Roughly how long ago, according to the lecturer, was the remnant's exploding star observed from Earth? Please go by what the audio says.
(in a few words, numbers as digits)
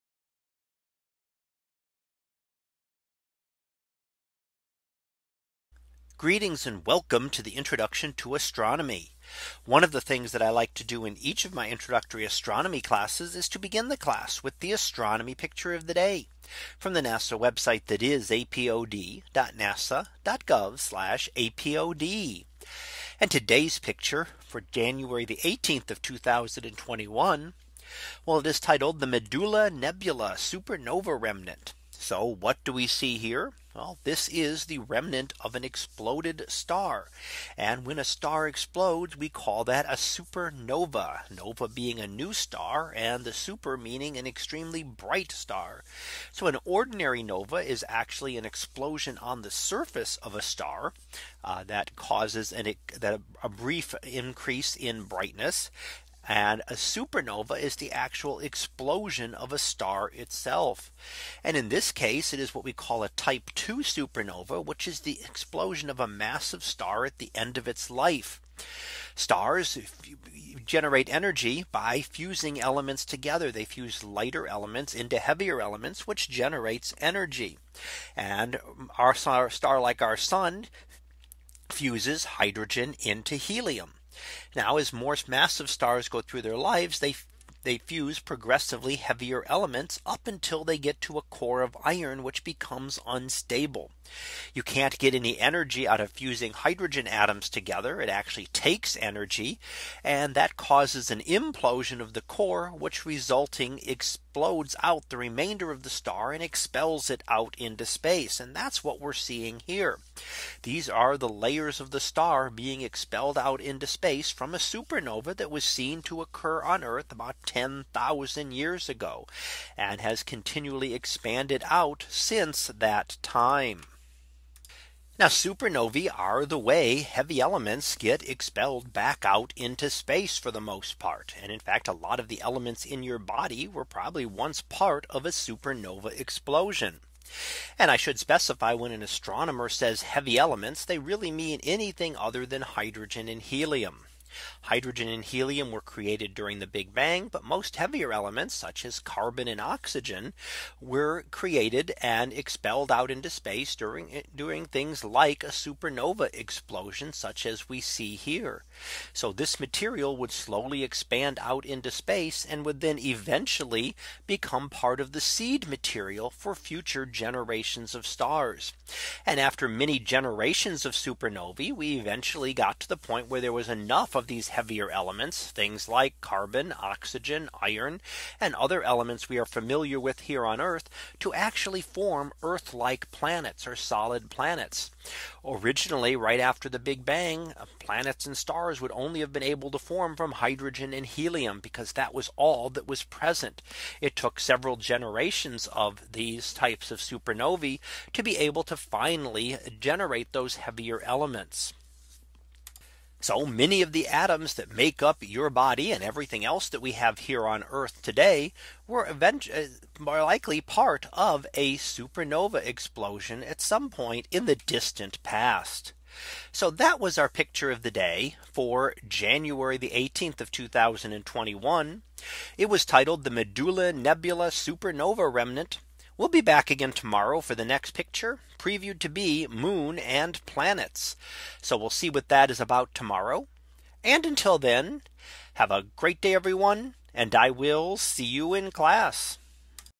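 10,000 years.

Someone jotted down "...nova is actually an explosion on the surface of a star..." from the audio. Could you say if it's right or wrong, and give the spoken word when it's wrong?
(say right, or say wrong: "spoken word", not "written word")
right.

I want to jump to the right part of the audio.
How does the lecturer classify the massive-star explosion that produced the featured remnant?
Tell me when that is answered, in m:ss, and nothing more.
1:03.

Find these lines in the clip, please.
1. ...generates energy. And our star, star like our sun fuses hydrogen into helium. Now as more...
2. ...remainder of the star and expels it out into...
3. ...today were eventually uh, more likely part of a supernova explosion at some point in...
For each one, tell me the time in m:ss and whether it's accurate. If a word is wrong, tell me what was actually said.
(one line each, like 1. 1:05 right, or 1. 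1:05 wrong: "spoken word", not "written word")
1. 1:16 right
2. 1:45 right
3. 3:28 right.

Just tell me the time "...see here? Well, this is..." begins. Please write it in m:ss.
0:32.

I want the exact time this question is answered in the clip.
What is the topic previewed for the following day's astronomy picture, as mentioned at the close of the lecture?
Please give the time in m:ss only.
3:49.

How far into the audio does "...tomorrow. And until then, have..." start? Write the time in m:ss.
3:52.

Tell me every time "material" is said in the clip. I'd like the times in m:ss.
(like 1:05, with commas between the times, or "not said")
2:39, 2:45.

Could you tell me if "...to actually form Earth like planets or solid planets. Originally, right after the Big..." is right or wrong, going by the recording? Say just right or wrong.
right.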